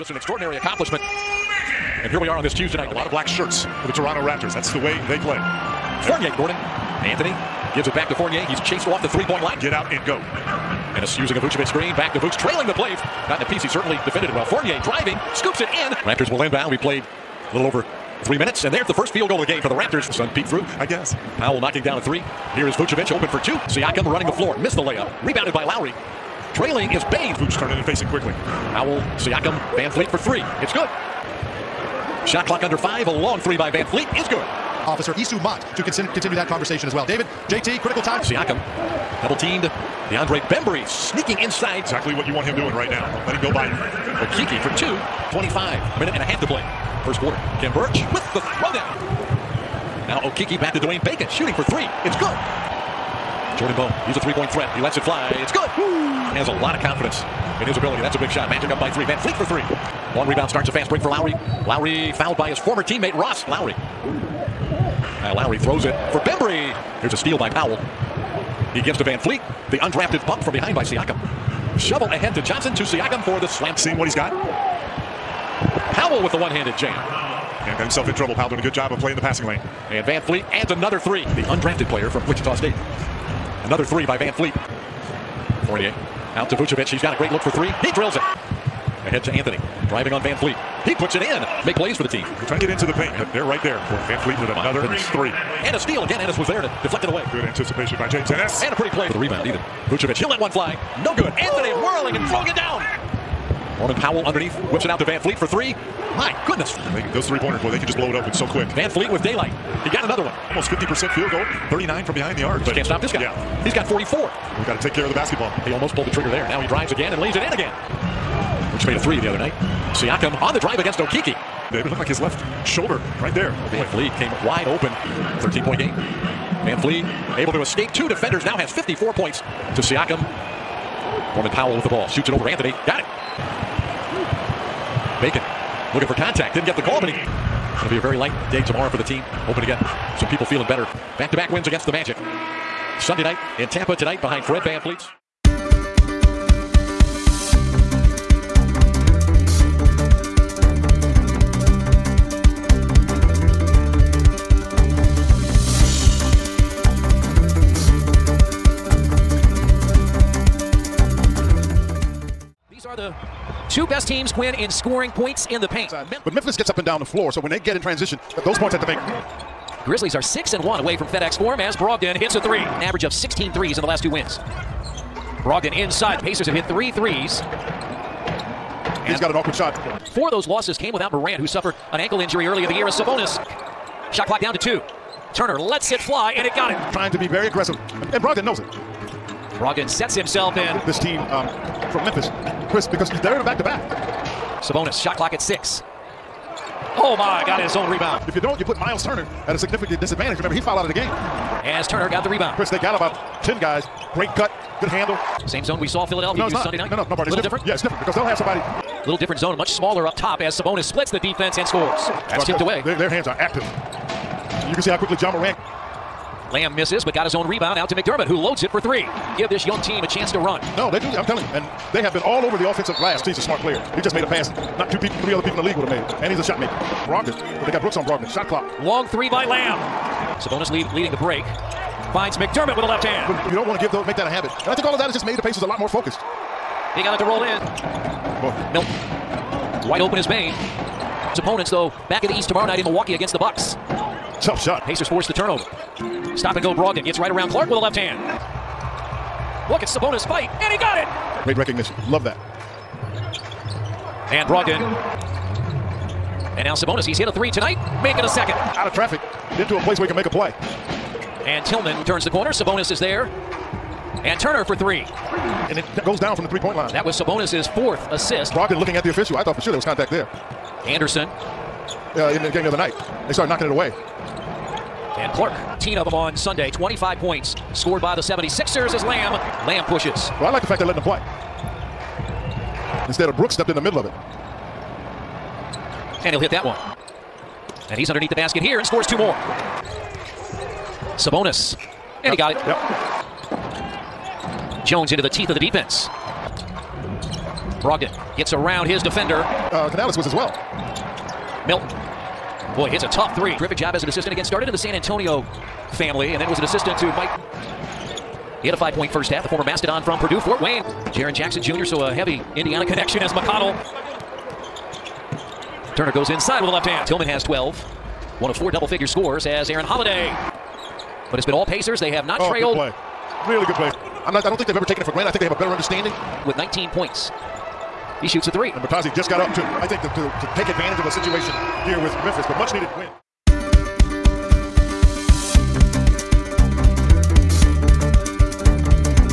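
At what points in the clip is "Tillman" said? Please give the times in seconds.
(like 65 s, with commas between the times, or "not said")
261 s, 317 s.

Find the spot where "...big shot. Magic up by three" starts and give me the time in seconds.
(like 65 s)
58 s.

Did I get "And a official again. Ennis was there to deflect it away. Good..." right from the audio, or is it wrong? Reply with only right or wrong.
wrong.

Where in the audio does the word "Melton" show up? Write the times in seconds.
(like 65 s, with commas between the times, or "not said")
238 s, 301 s.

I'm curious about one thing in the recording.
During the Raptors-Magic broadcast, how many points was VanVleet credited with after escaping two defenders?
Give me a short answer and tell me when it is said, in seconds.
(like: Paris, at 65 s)
54, at 128 s.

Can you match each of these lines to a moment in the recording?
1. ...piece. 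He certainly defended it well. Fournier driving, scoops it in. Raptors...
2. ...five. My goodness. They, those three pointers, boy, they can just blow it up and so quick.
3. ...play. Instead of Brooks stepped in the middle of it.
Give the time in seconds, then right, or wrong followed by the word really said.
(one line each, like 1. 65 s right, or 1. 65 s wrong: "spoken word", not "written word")
1. 13 s right
2. 105 s wrong: "three", not "five"
3. 281 s right.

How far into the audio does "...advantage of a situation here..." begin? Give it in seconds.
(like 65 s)
330 s.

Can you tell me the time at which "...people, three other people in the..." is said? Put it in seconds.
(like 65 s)
224 s.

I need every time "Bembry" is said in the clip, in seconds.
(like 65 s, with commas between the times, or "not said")
40 s, 66 s.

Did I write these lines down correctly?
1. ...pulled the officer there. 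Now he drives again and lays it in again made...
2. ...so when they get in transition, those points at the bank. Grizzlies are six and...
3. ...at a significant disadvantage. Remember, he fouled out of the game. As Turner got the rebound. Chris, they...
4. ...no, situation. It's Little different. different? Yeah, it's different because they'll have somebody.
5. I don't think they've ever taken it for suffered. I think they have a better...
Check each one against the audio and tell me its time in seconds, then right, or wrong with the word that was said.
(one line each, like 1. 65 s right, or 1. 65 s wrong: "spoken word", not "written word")
1. 115 s wrong: "trigger", not "officer"
2. 167 s right
3. 199 s right
4. 207 s wrong: "pardon", not "situation"
5. 324 s wrong: "granted", not "suffered".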